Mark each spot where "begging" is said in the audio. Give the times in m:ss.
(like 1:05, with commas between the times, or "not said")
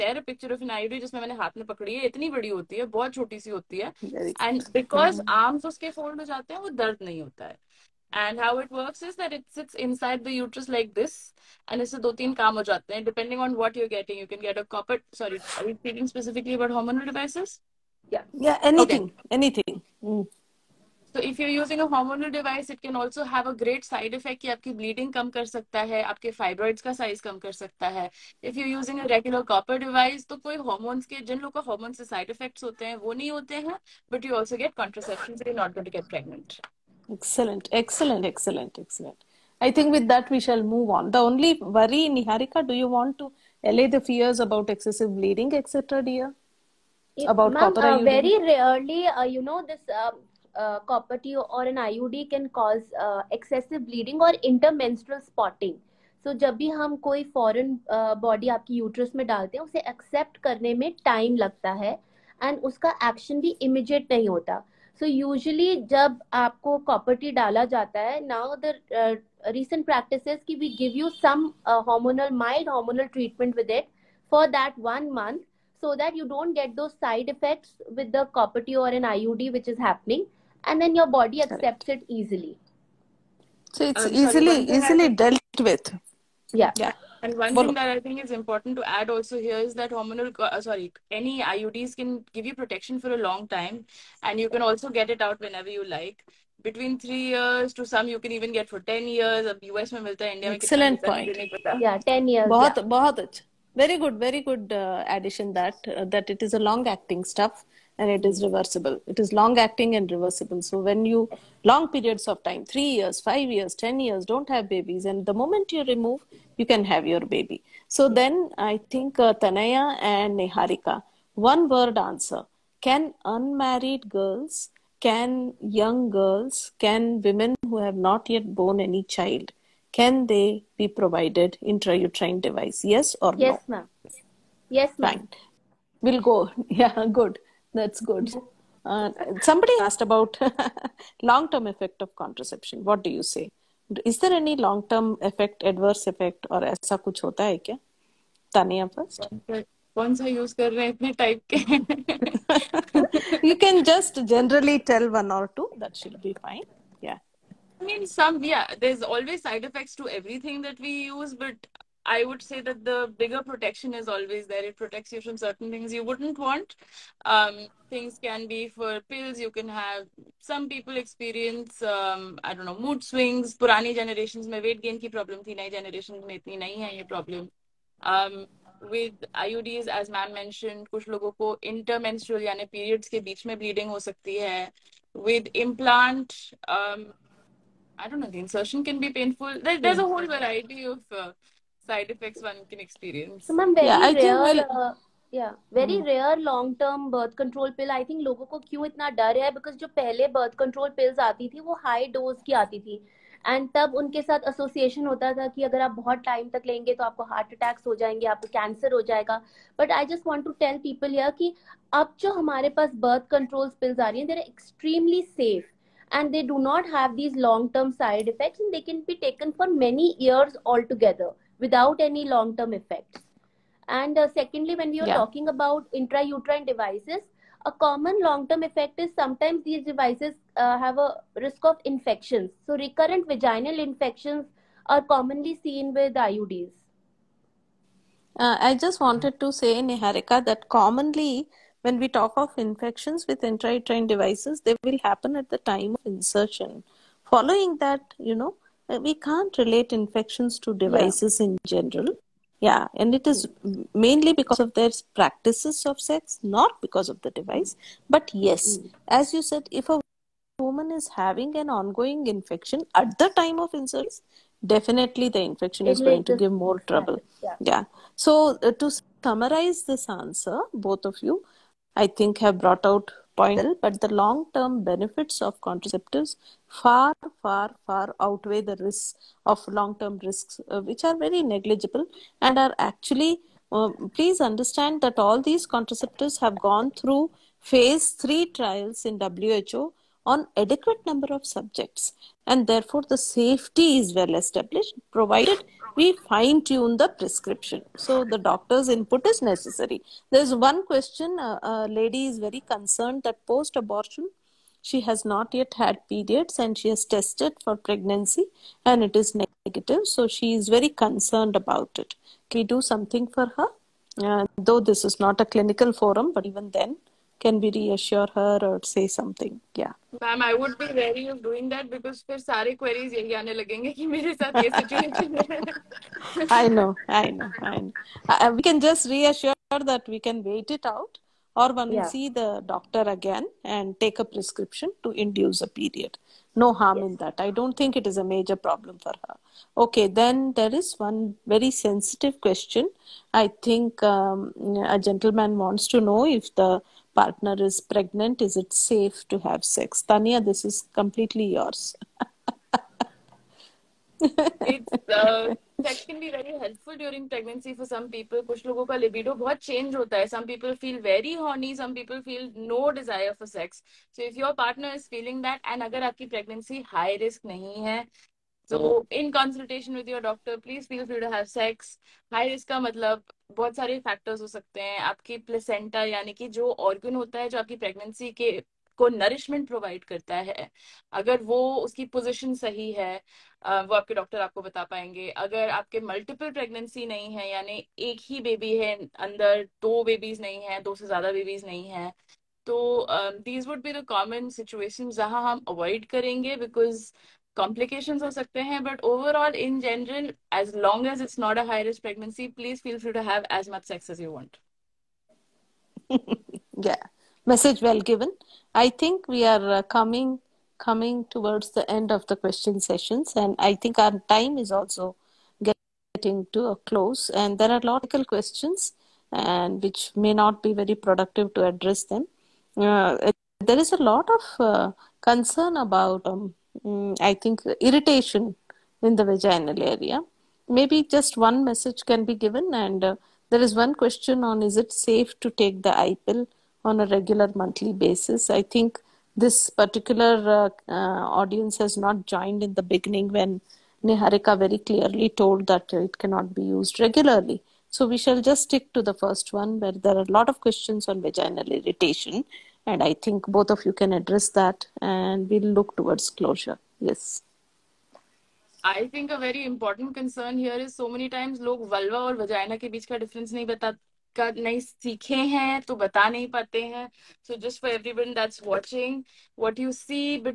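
not said.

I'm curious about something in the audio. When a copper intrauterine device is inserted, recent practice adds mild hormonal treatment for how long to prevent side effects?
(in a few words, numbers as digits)
1 month.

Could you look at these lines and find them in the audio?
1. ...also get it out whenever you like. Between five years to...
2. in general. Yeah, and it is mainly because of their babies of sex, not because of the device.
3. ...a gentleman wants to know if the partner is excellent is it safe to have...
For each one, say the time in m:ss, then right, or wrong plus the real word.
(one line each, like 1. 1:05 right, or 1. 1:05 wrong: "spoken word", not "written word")
1. 1:34 wrong: "three", not "five"
2. 4:11 wrong: "practices", not "babies"
3. 5:44 wrong: "pregnant", not "excellent".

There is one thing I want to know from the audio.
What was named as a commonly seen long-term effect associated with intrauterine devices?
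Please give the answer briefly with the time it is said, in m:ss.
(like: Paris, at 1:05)
Recurrent vaginal infections, at 3:52.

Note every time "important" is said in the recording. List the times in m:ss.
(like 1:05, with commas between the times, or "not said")
1:28, 7:39.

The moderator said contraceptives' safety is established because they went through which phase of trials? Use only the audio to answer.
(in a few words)
Phase 3.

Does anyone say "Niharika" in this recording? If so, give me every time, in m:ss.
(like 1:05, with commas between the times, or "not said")
0:42, 2:00, 3:59, 7:24.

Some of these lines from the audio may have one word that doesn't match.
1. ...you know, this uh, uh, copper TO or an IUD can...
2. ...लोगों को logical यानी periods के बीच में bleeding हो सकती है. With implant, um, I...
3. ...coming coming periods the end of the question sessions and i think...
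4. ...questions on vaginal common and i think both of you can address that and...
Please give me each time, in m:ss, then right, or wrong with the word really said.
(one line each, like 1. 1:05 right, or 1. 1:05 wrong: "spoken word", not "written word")
1. 0:49 right
2. 3:01 wrong: "intermenstrual", not "logical"
3. 6:49 wrong: "towards", not "periods"
4. 7:30 wrong: "irritation", not "common".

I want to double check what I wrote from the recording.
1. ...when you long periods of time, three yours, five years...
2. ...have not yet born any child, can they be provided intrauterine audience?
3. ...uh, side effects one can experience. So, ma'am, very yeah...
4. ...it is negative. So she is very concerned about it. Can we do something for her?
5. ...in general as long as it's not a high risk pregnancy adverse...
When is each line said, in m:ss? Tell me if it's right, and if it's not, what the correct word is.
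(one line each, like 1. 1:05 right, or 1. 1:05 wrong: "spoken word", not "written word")
1. 1:50 wrong: "years", not "yours"
2. 2:07 wrong: "device", not "audience"
3. 3:11 right
4. 5:09 right
5. 6:39 wrong: "please", not "adverse".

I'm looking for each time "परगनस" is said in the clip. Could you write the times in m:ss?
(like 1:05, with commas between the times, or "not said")
6:17, 6:26.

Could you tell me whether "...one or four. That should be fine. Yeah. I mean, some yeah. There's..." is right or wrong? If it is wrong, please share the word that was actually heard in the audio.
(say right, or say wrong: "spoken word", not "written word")
wrong: "two", not "four".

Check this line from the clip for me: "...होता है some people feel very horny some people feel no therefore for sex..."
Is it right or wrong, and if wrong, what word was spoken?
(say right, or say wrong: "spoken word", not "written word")
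wrong: "desire", not "therefore".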